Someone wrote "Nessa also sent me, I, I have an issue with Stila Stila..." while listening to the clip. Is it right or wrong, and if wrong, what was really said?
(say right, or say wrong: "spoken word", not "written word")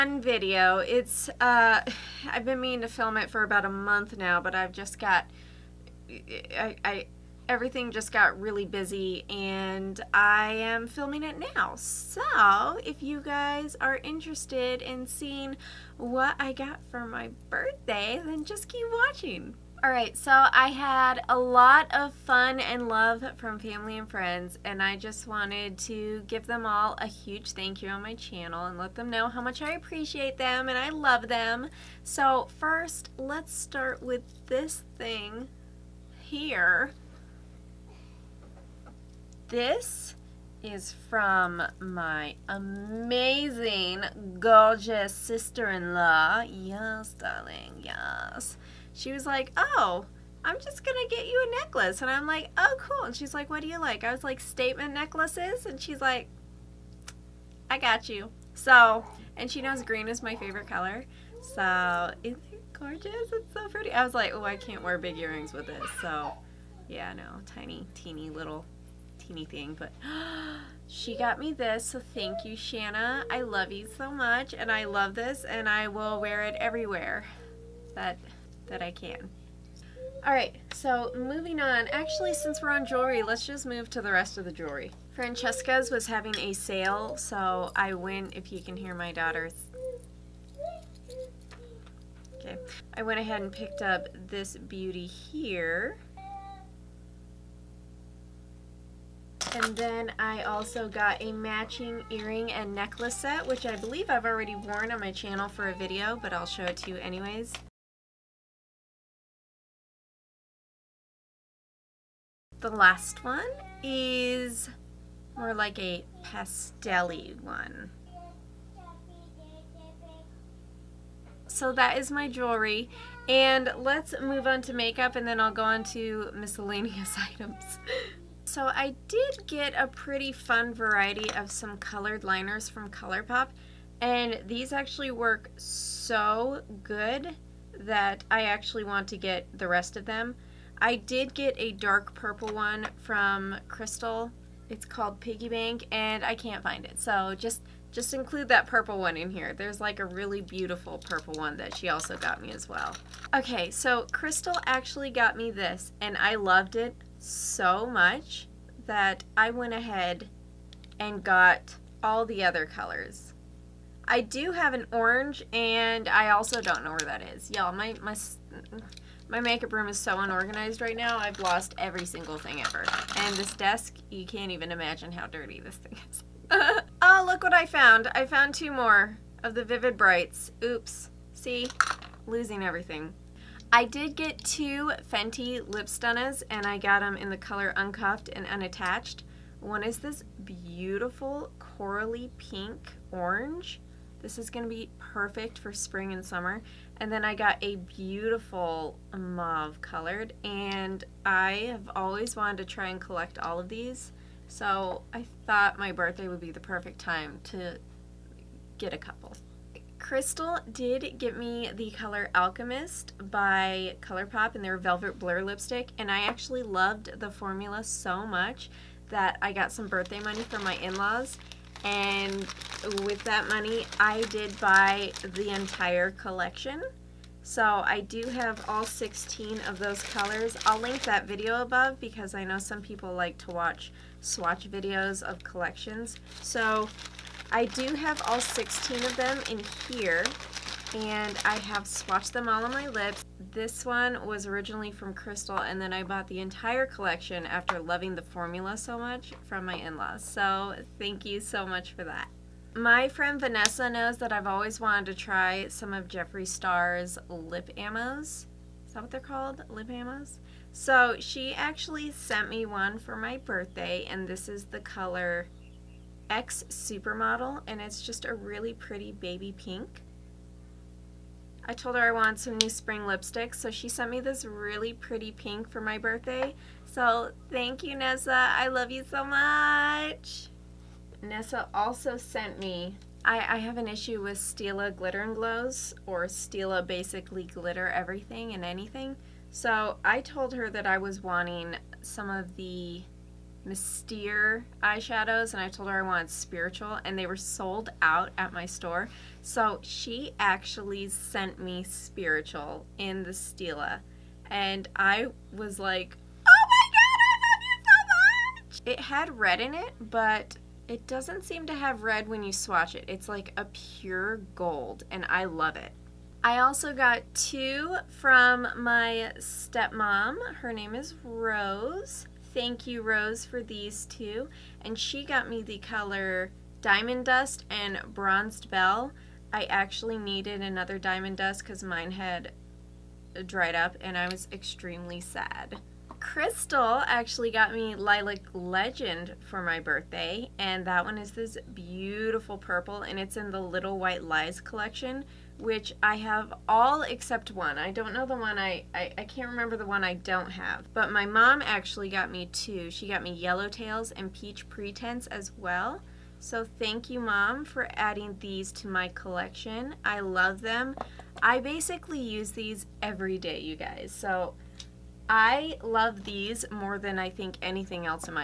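wrong: "Glitter", not "Stila".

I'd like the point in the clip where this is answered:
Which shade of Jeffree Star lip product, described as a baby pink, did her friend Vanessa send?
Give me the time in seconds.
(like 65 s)
266 s.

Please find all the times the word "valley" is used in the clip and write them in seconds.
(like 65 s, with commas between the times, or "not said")
not said.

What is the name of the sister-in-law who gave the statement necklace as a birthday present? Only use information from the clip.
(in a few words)
Shanna.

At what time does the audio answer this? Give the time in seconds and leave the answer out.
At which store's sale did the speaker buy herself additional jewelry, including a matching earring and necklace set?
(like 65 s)
85 s.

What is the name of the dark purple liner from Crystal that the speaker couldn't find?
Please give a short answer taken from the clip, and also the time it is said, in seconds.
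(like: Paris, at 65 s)
Piggy Bank, at 145 s.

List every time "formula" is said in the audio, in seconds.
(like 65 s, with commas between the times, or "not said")
217 s, 248 s.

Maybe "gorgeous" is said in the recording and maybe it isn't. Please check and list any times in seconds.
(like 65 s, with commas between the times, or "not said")
44 s, 62 s.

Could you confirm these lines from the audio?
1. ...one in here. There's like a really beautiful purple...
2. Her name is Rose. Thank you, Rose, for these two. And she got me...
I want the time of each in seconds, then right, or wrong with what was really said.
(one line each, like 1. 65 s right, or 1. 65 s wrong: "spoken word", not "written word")
1. 148 s right
2. 320 s right.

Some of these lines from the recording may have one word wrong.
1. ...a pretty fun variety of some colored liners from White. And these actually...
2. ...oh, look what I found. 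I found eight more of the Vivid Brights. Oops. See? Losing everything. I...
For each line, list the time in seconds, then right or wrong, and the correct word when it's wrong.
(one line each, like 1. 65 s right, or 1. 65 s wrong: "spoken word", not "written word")
1. 129 s wrong: "ColourPop", not "White"
2. 177 s wrong: "two", not "eight".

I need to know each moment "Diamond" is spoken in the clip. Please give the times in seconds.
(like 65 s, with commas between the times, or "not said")
326 s, 330 s.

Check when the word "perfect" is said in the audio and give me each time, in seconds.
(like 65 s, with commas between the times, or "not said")
194 s, 206 s.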